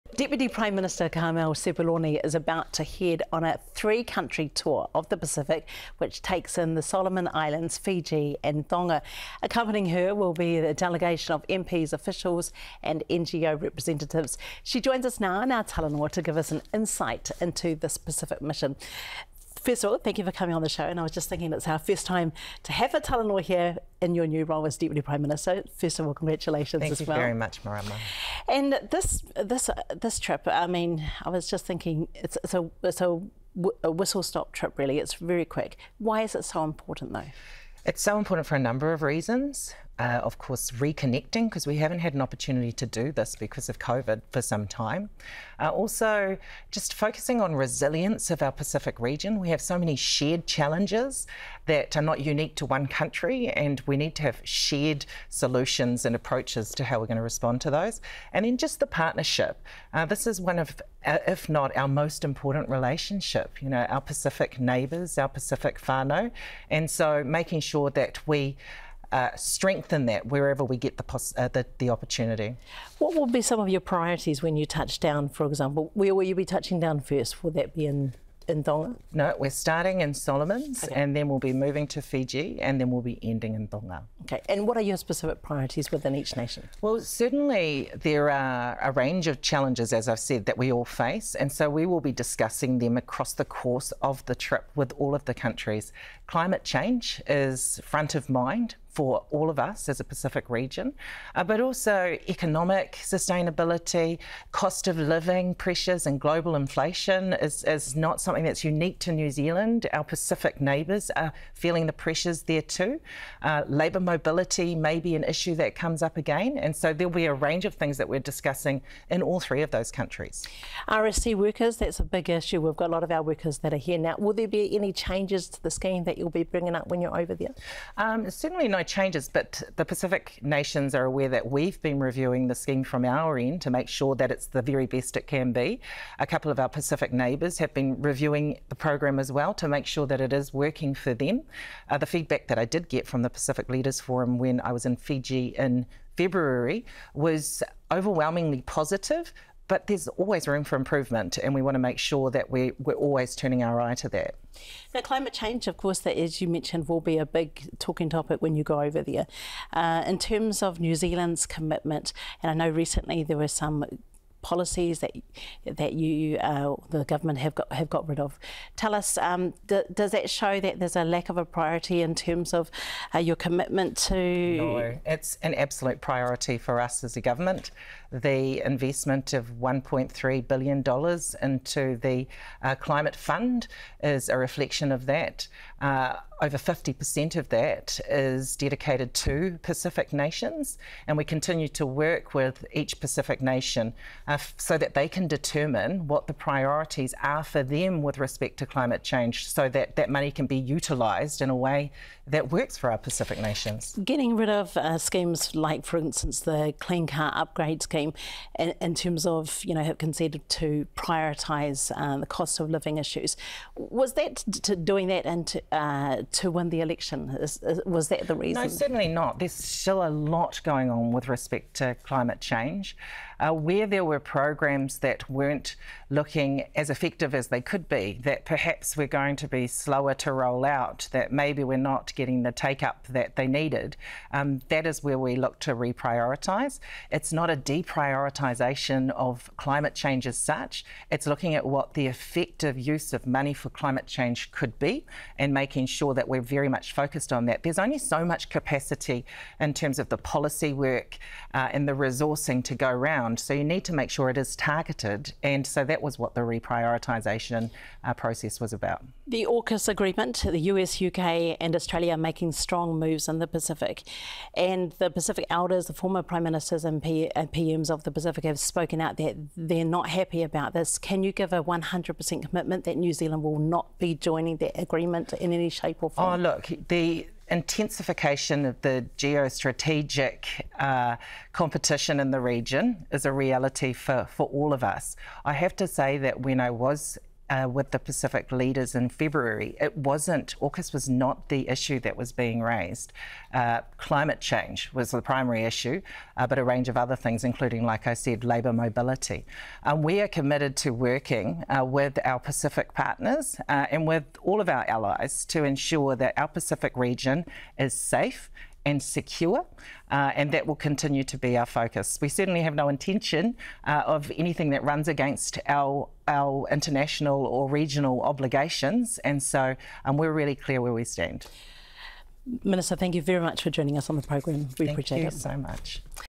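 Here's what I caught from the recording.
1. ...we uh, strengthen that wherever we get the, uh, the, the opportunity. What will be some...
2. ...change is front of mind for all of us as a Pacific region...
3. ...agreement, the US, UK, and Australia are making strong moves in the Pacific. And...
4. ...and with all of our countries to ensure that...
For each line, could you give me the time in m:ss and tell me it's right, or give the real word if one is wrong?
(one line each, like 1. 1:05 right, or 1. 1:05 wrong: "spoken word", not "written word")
1. 1:08 right
2. 1:36 right
3. 4:19 right
4. 5:03 wrong: "allies", not "countries".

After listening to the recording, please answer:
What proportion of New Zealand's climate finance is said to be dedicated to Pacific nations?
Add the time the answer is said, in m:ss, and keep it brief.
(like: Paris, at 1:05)
Over 50%, at 3:06.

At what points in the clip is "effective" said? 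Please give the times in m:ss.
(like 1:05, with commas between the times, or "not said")
3:46, 4:02.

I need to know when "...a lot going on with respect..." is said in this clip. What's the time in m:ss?
3:40.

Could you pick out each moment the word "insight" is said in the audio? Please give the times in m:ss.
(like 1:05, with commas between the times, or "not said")
0:16.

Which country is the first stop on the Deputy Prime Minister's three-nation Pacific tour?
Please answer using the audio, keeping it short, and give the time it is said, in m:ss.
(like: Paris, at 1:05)
Solomon Islands, at 1:20.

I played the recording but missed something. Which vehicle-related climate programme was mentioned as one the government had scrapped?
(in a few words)
Clean Car Upgrade Scheme.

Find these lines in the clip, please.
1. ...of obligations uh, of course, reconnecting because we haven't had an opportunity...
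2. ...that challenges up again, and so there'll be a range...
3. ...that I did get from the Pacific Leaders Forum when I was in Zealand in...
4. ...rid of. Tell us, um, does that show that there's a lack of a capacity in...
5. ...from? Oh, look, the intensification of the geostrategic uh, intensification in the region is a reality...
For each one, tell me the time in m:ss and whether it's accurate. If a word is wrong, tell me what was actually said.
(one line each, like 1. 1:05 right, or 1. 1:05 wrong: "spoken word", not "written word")
1. 0:38 wrong: "reasons", not "obligations"
2. 1:55 wrong: "comes", not "challenges"
3. 2:22 wrong: "Fiji", not "Zealand"
4. 2:48 wrong: "priority", not "capacity"
5. 4:36 wrong: "competition", not "intensification".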